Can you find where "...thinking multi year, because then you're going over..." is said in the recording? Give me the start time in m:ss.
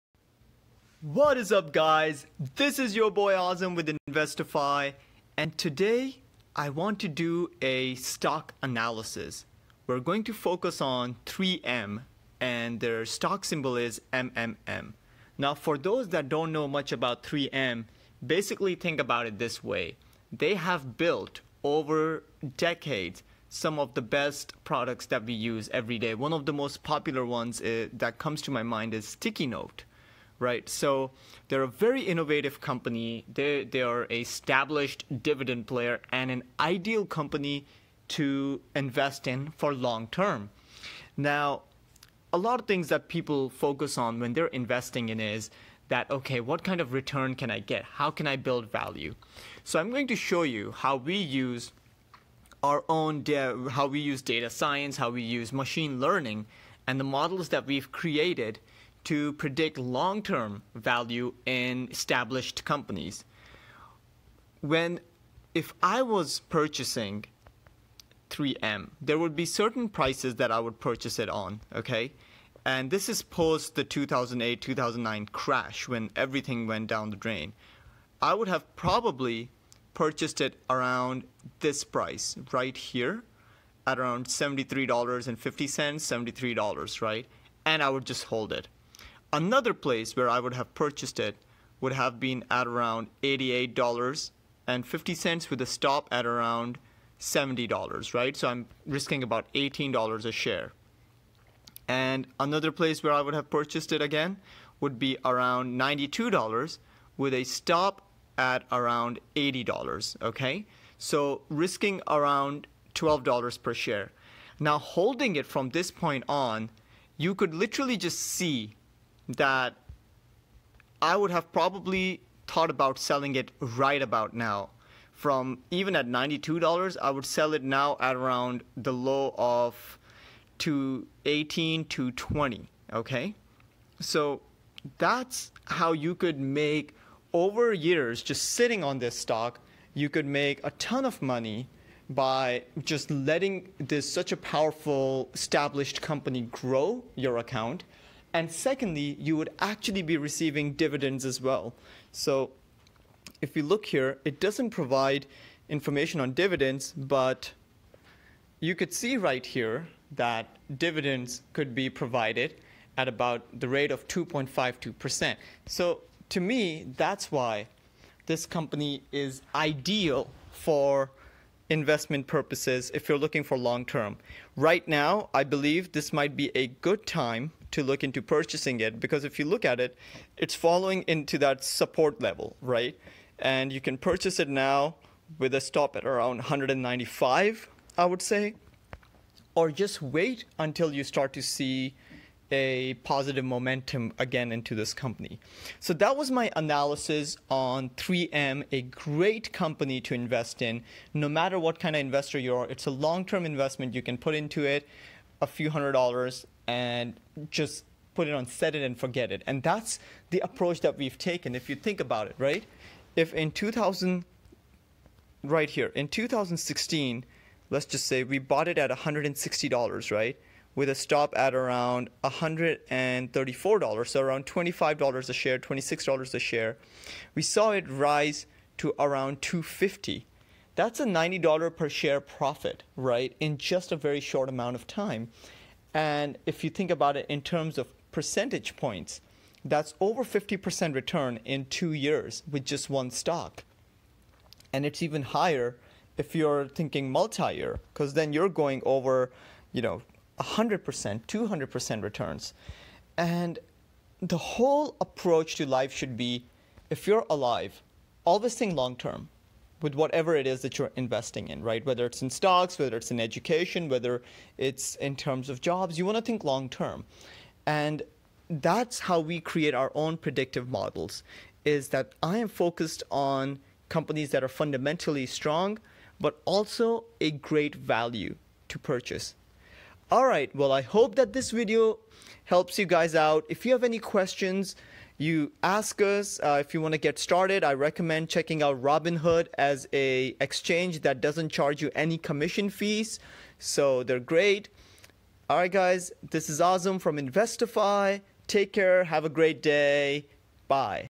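4:06.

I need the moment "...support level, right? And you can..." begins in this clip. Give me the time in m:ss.
3:01.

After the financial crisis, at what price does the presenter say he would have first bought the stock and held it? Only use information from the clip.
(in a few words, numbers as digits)
$73.50.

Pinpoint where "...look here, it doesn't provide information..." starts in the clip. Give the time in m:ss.
2:33.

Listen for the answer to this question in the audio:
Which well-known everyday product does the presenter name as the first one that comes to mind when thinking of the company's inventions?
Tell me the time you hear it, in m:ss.
0:29.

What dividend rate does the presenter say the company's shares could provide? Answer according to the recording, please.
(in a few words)
2.52%.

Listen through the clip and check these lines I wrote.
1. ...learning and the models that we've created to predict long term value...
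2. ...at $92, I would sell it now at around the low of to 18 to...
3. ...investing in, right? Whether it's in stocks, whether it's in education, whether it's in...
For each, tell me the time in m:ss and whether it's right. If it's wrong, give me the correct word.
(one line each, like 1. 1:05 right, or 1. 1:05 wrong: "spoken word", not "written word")
1. 0:55 right
2. 2:05 right
3. 4:20 right.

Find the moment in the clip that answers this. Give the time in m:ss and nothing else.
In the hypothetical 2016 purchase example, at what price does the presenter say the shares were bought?
3:38.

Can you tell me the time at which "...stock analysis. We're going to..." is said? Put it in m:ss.
0:07.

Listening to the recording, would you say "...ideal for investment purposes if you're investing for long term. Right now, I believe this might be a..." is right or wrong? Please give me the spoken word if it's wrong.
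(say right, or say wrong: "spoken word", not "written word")
wrong: "looking", not "investing".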